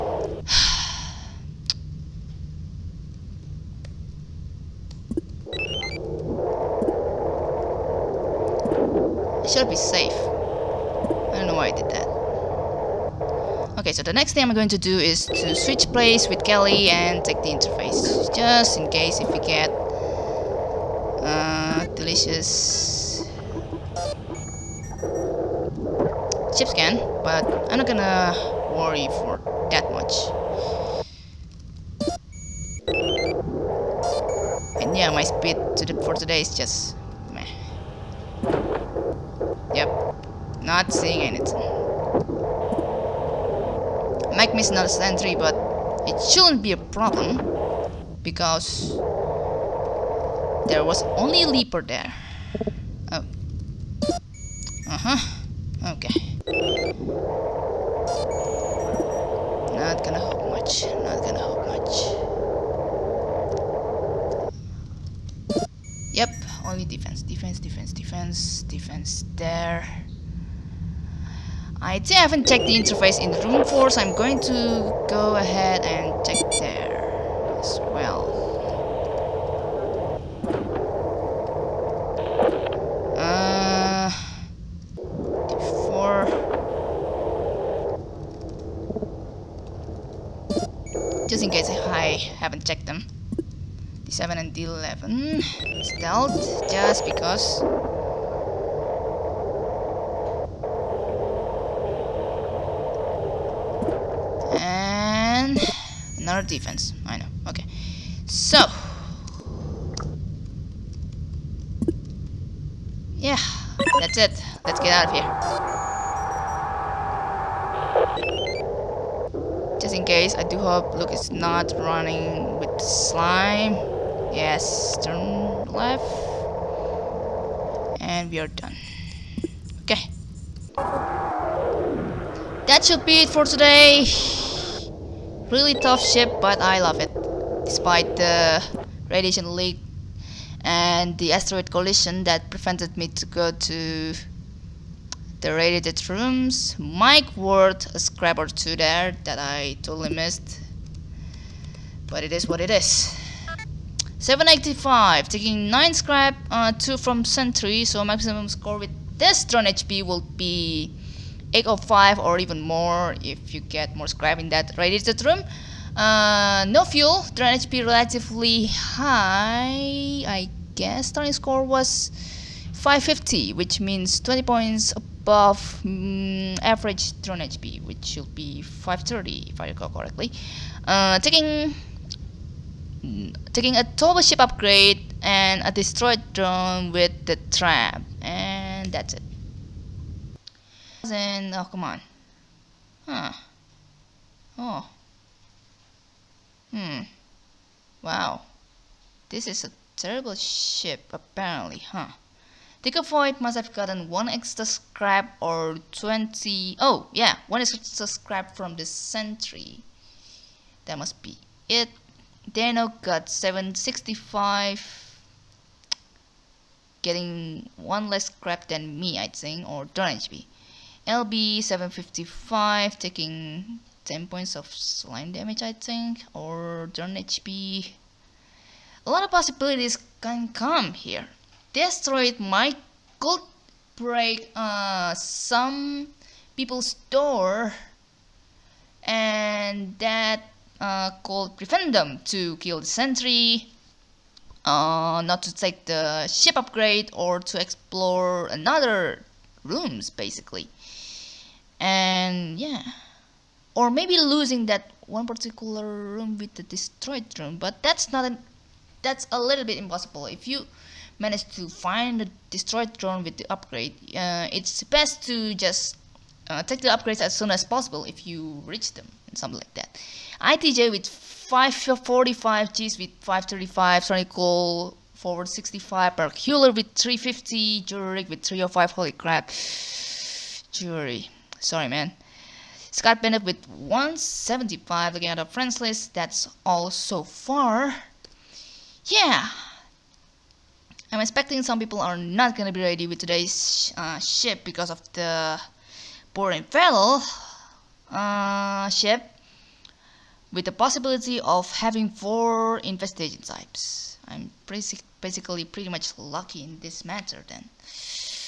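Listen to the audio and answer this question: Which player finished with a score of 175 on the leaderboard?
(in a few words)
Scott Bennett.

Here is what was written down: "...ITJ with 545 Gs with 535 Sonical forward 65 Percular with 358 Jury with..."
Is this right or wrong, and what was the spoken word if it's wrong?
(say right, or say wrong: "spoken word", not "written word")
wrong: "350", not "358".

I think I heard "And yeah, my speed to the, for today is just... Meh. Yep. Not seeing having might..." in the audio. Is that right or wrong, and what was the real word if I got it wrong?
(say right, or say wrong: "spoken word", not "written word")
wrong: "anything", not "having".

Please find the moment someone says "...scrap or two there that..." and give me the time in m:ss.
2:27.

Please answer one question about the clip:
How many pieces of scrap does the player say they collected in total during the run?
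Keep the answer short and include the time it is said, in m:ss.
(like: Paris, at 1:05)
9, at 2:35.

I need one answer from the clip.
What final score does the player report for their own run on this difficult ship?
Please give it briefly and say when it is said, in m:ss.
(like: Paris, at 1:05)
785, at 2:34.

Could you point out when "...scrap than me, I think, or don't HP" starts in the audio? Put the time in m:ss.
3:38.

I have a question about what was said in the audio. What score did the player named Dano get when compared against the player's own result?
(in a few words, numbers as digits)
765.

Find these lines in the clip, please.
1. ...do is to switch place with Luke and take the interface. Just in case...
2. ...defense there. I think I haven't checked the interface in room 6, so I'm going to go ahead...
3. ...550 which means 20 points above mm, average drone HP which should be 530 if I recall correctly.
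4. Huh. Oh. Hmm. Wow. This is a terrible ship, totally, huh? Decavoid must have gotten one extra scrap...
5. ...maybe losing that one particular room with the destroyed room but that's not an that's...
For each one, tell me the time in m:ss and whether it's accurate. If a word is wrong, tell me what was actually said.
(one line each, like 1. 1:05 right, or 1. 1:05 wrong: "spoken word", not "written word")
1. 0:14 wrong: "Kelly", not "Luke"
2. 1:08 wrong: "4", not "6"
3. 2:52 right
4. 3:13 wrong: "apparently", not "totally"
5. 4:13 right.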